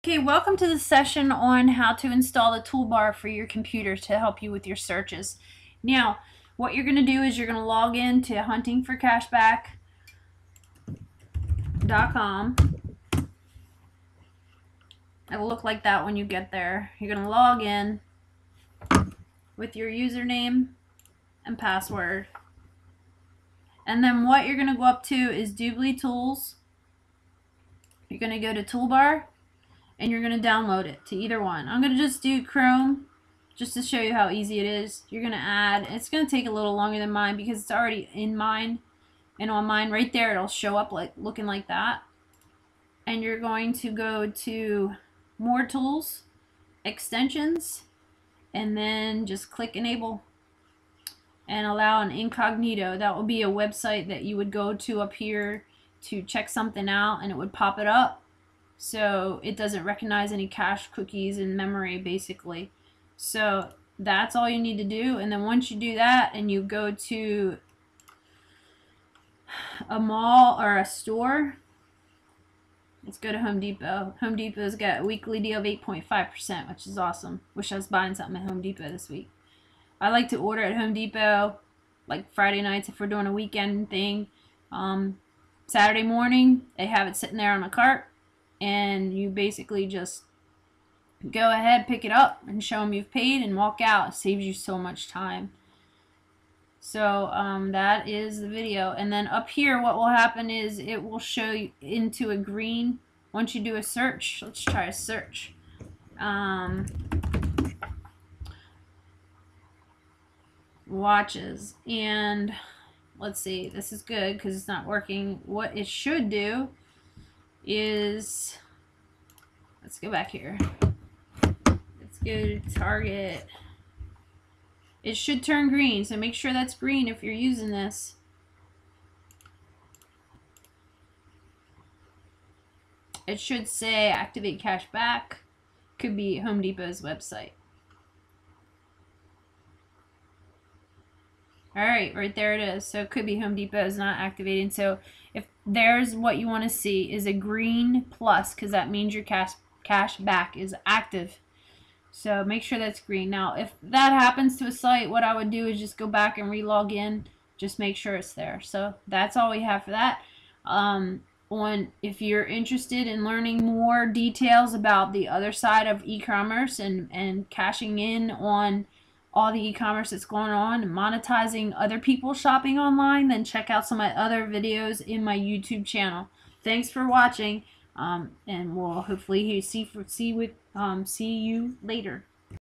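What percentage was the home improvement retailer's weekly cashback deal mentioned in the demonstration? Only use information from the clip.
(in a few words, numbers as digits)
8.5%.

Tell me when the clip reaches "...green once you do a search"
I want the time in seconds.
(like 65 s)
102 s.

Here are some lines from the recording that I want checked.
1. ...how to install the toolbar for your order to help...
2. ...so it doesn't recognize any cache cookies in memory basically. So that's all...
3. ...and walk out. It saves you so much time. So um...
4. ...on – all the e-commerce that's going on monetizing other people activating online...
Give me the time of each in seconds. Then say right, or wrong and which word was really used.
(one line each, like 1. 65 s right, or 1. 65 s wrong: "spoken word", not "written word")
1. 1 s wrong: "computer", not "order"
2. 58 s right
3. 93 s right
4. 168 s wrong: "shopping", not "activating".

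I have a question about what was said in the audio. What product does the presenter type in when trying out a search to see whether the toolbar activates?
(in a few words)
Watches.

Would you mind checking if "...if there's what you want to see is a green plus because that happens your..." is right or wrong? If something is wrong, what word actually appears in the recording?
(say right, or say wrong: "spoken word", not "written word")
wrong: "means", not "happens".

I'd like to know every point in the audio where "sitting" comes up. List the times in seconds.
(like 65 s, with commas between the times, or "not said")
87 s.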